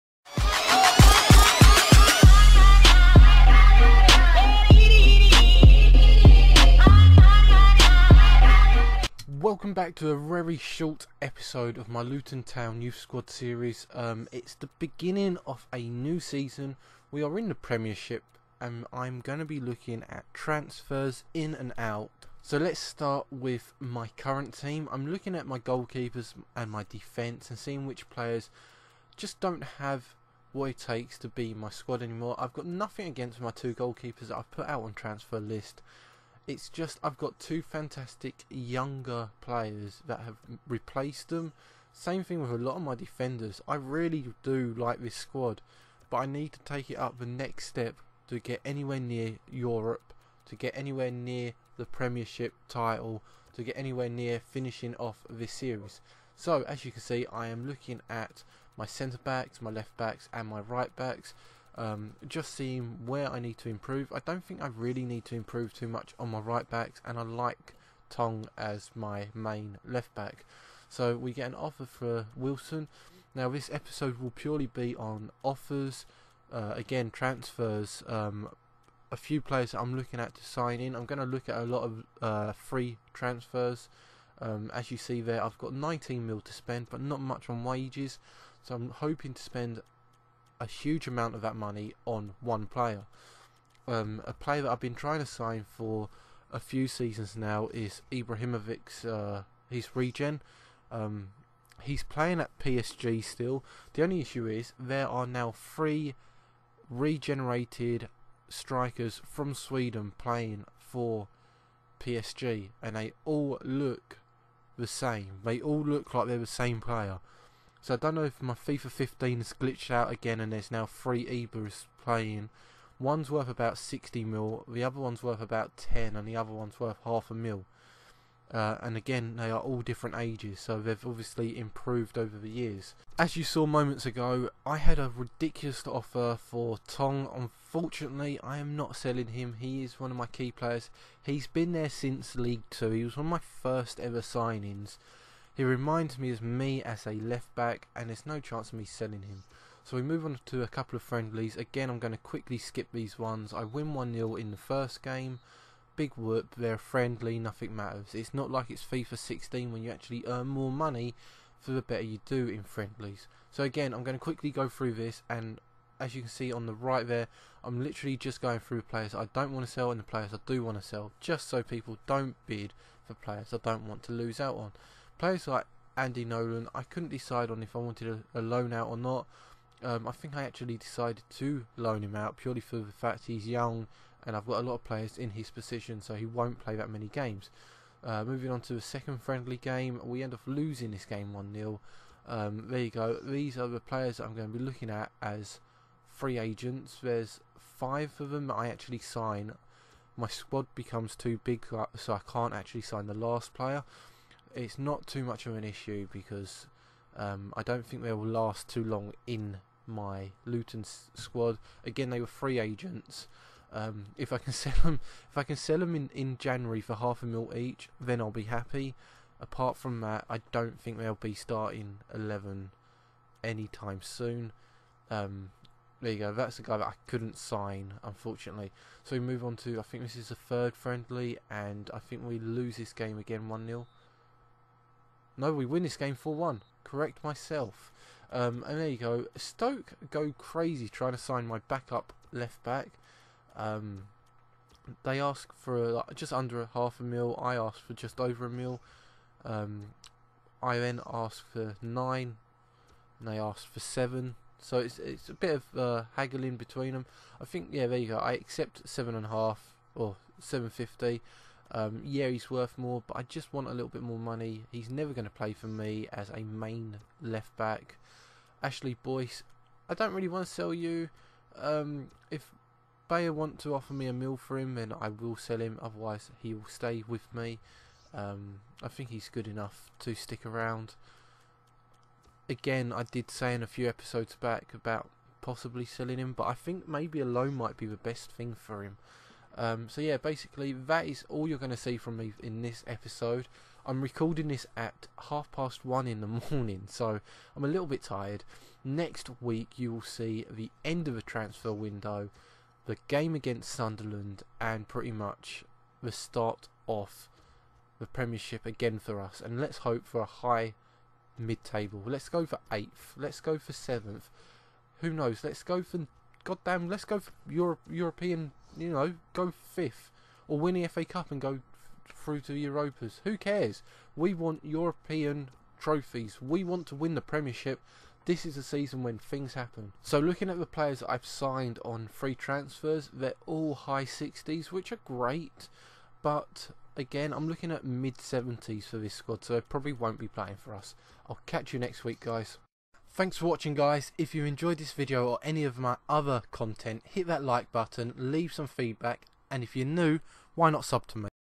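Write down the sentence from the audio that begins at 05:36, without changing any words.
But again, I'm looking at mid 70s for this squad, so it probably won't be playing for us.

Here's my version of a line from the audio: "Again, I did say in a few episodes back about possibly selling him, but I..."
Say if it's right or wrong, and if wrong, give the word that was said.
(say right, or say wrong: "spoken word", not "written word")
right.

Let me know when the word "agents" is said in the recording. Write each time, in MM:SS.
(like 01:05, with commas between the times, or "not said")
03:16, 03:32.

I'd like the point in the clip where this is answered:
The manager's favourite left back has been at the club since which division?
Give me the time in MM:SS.
02:22.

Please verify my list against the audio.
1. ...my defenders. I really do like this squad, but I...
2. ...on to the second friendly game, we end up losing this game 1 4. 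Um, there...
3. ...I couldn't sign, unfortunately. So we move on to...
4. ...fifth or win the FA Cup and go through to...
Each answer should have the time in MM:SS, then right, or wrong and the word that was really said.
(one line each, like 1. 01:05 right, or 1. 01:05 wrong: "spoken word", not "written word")
1. 00:42 right
2. 03:08 wrong: "0", not "4"
3. 03:46 right
4. 05:19 right.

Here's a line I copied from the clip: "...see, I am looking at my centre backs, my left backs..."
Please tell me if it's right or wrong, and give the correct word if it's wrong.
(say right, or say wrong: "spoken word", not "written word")
right.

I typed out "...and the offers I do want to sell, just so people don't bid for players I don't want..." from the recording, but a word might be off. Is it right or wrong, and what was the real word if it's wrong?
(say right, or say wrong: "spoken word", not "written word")
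wrong: "players", not "offers".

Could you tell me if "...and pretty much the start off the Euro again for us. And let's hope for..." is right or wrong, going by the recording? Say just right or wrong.
wrong.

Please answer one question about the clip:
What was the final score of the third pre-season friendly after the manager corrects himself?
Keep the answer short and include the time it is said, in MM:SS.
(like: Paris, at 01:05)
4-1, at 03:56.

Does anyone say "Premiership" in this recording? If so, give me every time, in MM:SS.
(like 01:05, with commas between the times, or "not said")
00:17, 00:51, 05:08, 05:27.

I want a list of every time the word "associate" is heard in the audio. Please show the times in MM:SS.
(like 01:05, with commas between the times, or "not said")
not said.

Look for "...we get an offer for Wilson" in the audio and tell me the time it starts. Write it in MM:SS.
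01:11.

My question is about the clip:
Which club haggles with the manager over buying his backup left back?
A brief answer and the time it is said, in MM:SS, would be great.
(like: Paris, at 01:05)
Stoke, at 03:59.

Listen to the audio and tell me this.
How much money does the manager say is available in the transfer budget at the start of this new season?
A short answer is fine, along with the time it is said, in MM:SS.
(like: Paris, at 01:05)
19 mil, at 01:25.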